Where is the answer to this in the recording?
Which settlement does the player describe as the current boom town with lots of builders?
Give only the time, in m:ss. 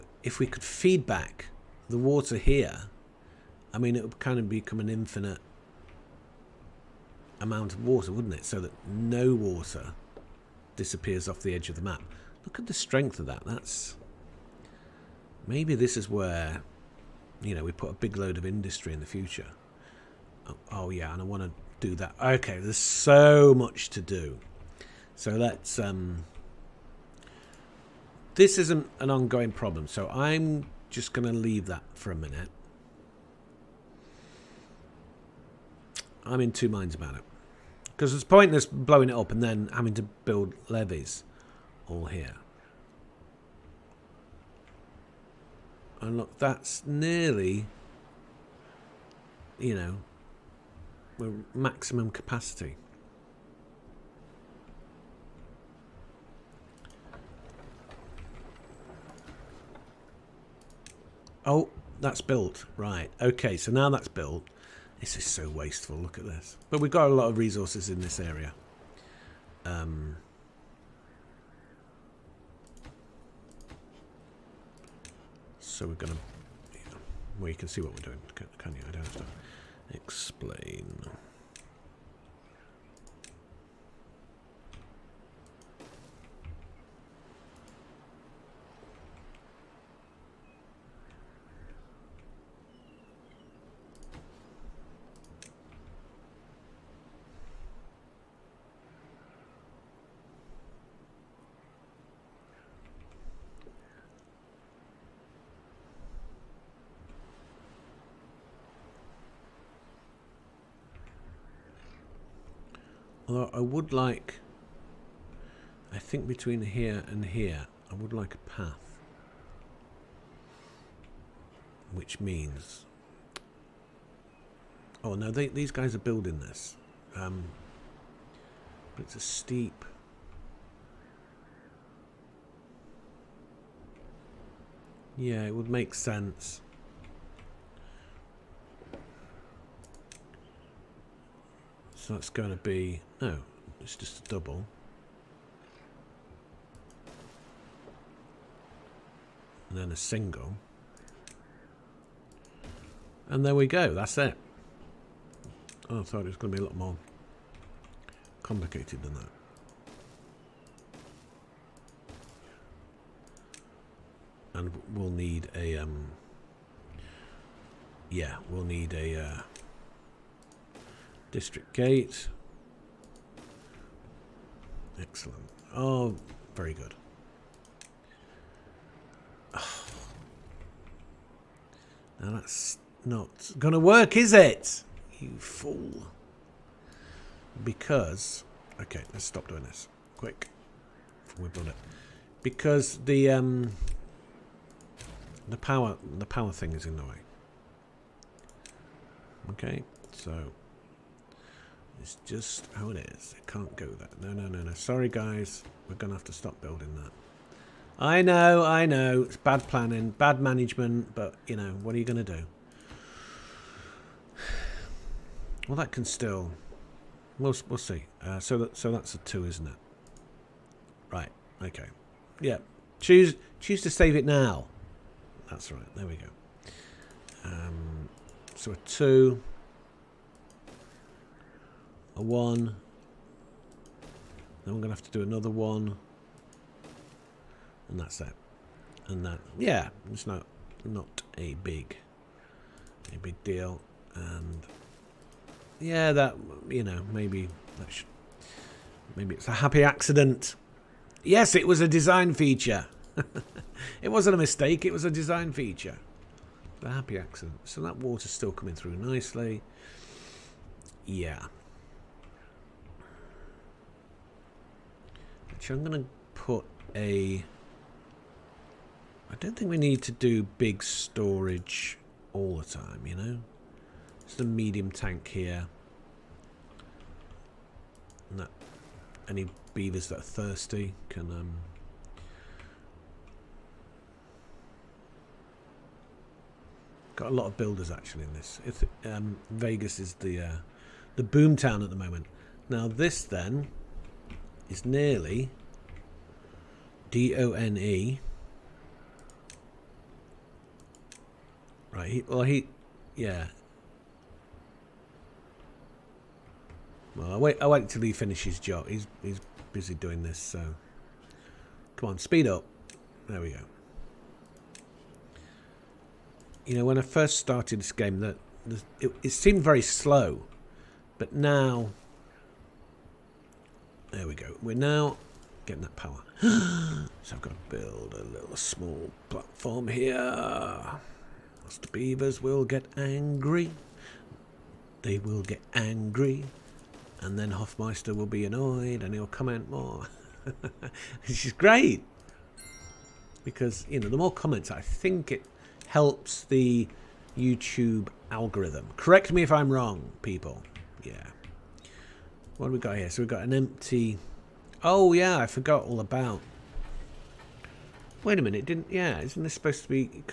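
4:49.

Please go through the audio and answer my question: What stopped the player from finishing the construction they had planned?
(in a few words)
The power thing.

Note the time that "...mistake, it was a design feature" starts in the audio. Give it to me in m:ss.
4:14.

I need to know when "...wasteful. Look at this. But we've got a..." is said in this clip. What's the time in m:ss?
1:05.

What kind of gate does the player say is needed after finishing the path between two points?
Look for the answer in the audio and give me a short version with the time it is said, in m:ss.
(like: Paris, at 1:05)
District gate, at 2:51.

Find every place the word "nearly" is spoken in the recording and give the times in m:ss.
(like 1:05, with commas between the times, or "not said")
0:46, 4:54.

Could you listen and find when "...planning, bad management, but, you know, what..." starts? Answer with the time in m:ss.
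3:29.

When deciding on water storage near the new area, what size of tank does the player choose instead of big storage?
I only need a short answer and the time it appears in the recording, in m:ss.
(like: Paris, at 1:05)
Medium tank, at 4:34.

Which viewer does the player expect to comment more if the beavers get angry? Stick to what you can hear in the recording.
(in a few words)
Hoffmeister.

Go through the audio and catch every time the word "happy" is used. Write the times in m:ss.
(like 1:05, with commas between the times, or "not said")
4:09, 4:16.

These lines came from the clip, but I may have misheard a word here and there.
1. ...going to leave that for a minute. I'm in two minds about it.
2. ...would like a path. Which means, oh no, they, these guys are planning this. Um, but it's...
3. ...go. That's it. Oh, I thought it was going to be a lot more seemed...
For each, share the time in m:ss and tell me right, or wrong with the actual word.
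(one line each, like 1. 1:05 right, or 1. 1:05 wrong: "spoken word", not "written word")
1. 0:31 right
2. 1:57 wrong: "building", not "planning"
3. 2:33 wrong: "complicated", not "seemed".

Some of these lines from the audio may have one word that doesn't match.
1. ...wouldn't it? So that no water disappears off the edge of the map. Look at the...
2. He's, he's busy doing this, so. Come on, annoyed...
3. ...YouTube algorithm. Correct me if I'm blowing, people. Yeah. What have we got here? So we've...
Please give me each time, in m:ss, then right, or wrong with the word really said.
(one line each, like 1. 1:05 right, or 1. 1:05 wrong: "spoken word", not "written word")
1. 0:08 right
2. 5:08 wrong: "speed", not "annoyed"
3. 5:47 wrong: "wrong", not "blowing".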